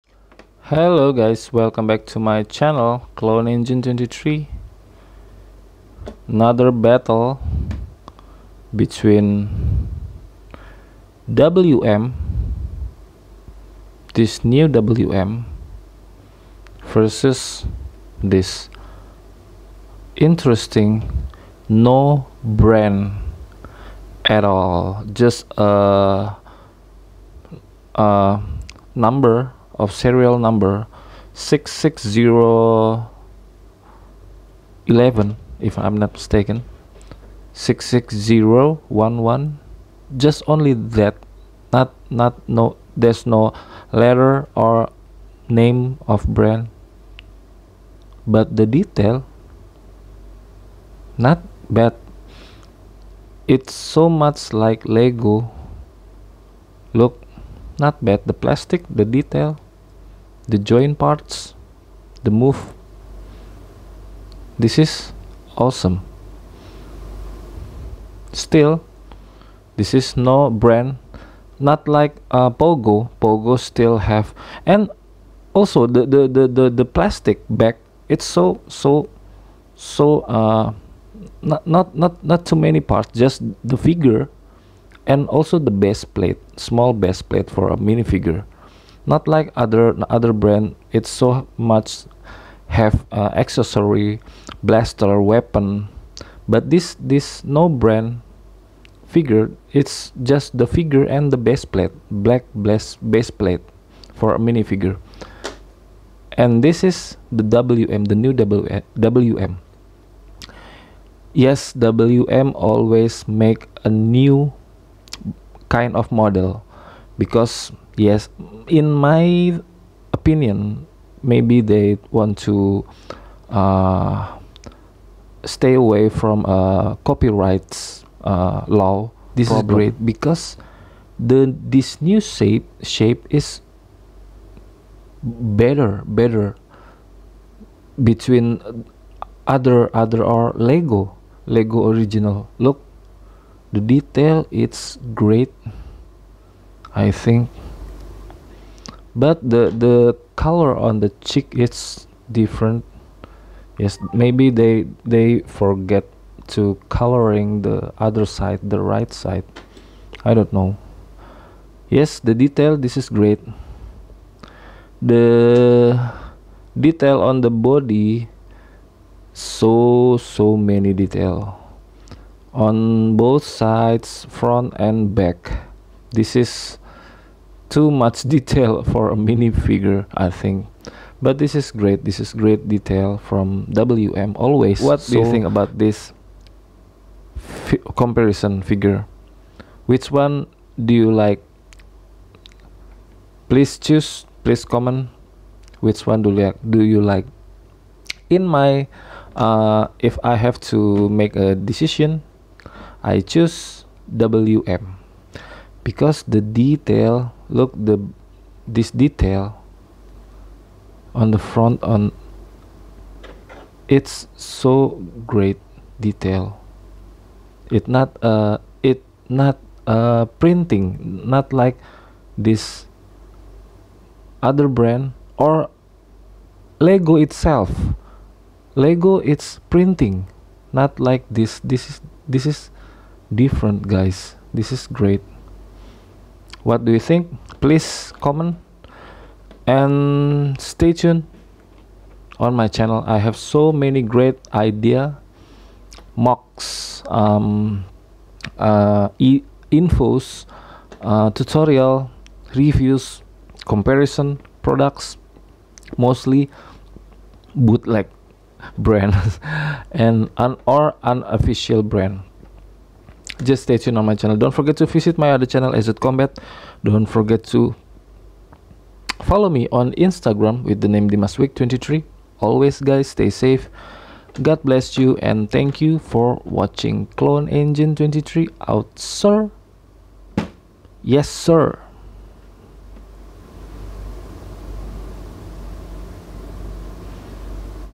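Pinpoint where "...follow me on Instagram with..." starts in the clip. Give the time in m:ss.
4:29.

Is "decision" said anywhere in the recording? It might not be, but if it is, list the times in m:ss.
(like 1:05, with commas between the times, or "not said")
3:21.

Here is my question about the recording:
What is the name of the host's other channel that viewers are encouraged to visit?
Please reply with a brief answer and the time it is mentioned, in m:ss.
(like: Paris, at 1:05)
EZED Combat, at 4:25.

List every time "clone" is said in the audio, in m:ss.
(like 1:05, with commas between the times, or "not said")
0:03, 4:37.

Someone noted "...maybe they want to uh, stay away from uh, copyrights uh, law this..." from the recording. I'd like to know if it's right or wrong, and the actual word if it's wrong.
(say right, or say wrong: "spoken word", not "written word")
right.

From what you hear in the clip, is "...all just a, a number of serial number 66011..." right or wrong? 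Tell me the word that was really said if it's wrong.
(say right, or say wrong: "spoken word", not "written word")
right.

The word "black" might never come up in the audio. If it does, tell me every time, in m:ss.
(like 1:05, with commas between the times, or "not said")
1:42.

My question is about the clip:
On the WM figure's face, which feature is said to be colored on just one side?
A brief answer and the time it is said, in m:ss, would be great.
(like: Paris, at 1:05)
The cheek, at 2:31.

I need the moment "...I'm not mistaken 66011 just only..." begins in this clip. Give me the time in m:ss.
0:35.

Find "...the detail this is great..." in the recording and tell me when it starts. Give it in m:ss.
2:42.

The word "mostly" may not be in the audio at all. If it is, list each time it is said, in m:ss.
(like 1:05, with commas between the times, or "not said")
4:15.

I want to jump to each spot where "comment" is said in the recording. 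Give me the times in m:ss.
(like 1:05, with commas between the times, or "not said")
3:14, 3:58.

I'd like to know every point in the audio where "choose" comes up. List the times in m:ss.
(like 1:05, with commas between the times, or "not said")
3:13, 3:23.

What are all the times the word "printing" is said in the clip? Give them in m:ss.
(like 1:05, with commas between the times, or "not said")
3:40, 3:49.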